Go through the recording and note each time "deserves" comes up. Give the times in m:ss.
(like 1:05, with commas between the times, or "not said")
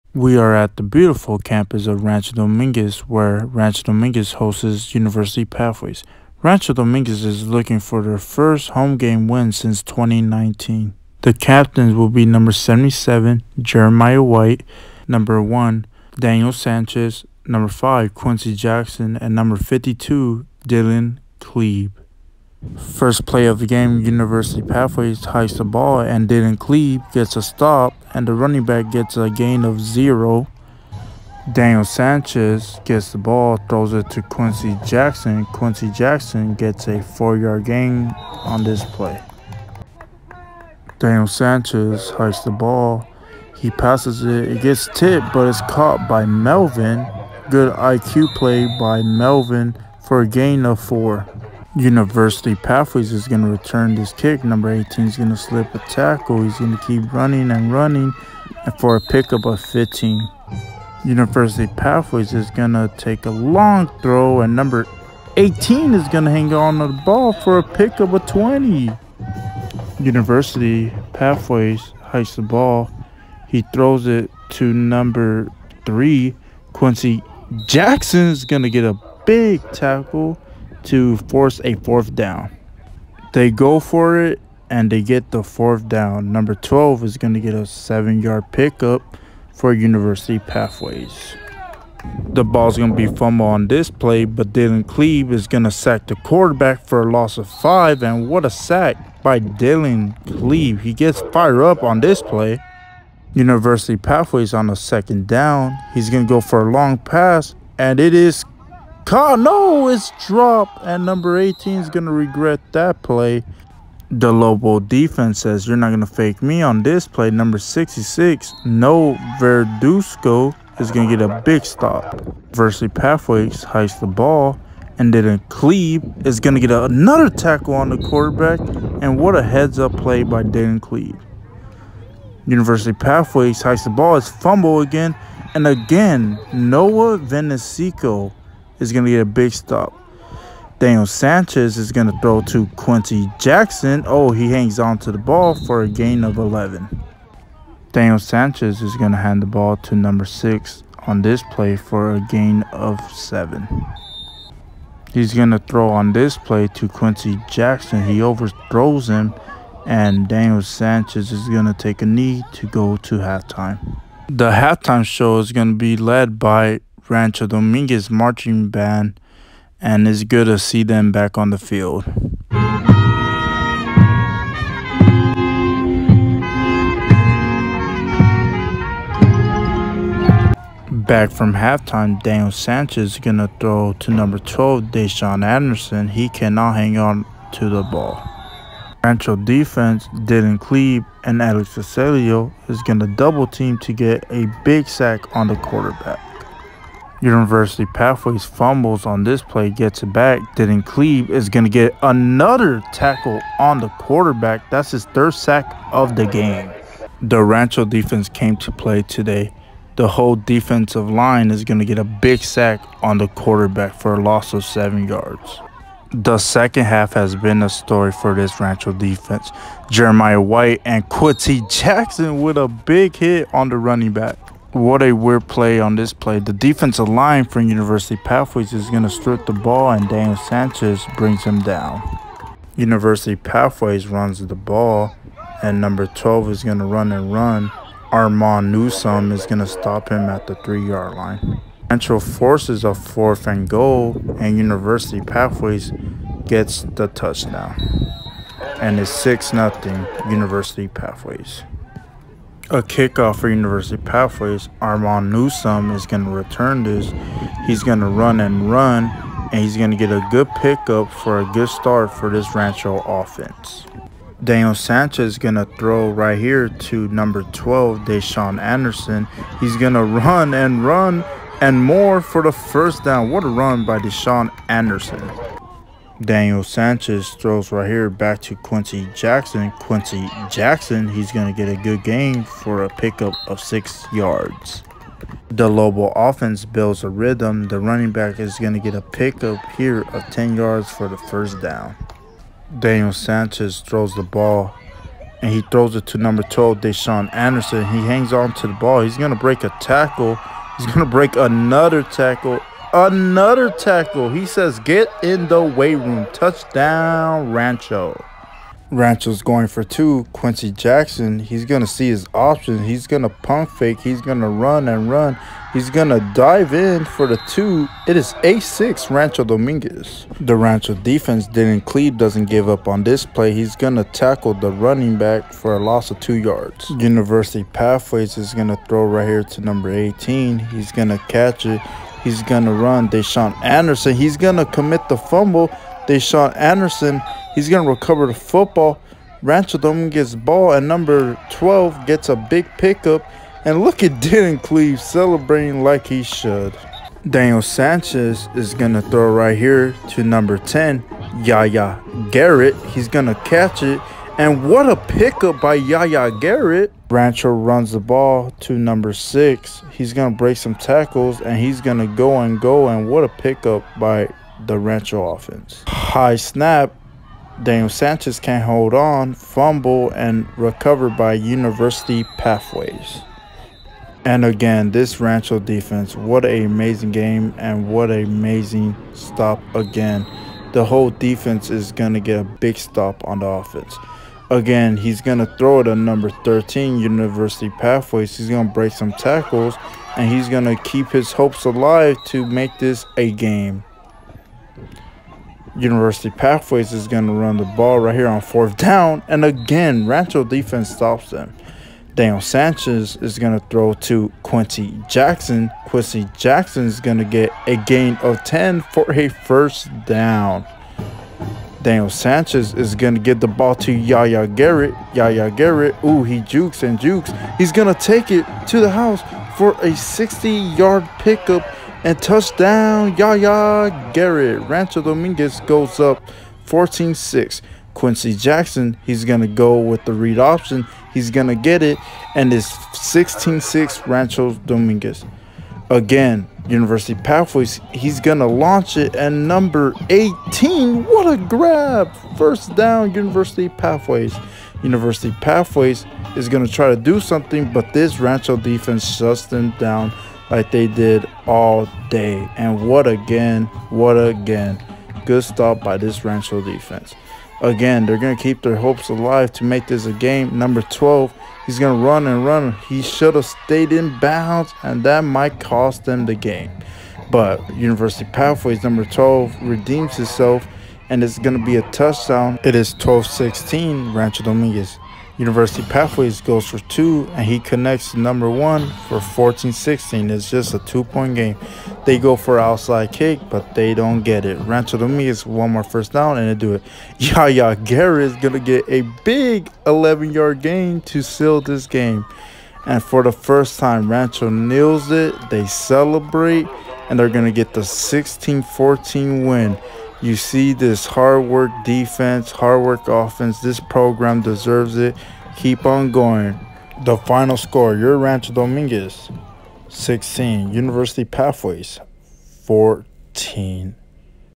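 8:24.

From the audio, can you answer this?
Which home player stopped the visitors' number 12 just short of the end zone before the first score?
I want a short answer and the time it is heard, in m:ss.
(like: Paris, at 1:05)
Armand Newsom, at 3:58.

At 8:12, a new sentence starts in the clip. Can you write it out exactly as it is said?
And for the first time, Rancho nails it.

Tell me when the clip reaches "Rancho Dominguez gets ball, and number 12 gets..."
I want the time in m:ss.
5:39.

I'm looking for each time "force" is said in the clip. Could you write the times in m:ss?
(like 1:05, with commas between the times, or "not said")
1:21, 4:02.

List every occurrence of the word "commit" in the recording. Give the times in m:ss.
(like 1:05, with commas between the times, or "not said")
5:34.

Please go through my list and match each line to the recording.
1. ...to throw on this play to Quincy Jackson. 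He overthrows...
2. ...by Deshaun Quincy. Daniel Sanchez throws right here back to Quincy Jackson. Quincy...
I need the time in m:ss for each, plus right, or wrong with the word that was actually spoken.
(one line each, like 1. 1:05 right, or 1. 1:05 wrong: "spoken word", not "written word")
1. 2:35 right
2. 4:33 wrong: "Anderson", not "Quincy".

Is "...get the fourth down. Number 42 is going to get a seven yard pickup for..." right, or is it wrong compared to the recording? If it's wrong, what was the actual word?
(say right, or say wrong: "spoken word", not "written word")
wrong: "12", not "42".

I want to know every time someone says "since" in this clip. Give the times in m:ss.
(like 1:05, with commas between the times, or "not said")
0:09.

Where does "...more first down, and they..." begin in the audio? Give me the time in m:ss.
8:05.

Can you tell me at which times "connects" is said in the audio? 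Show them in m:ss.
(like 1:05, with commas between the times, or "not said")
7:57.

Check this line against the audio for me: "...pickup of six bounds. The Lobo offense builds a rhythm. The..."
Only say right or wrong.
wrong.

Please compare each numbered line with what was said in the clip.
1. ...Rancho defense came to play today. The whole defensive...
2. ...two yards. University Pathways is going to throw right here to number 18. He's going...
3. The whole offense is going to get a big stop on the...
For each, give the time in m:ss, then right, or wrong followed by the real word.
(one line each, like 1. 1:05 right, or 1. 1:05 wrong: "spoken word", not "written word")
1. 3:27 right
2. 5:26 right
3. 6:20 wrong: "defense", not "offense".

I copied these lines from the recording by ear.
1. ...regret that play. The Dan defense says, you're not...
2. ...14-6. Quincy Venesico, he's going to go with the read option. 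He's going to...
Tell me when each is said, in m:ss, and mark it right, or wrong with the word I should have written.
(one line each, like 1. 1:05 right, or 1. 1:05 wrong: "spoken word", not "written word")
1. 1:52 wrong: "Lobo", not "Dan"
2. 7:06 wrong: "Jackson", not "Venesico".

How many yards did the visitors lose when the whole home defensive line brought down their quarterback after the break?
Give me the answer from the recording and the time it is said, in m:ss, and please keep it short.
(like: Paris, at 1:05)
7, at 3:34.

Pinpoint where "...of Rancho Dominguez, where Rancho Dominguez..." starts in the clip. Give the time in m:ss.
0:01.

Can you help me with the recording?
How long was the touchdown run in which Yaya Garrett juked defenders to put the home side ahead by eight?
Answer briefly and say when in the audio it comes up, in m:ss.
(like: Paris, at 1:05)
60 yards, at 6:59.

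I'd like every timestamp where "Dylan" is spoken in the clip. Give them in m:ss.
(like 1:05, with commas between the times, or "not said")
0:20, 1:34, 1:39, 3:10, 5:21, 5:44.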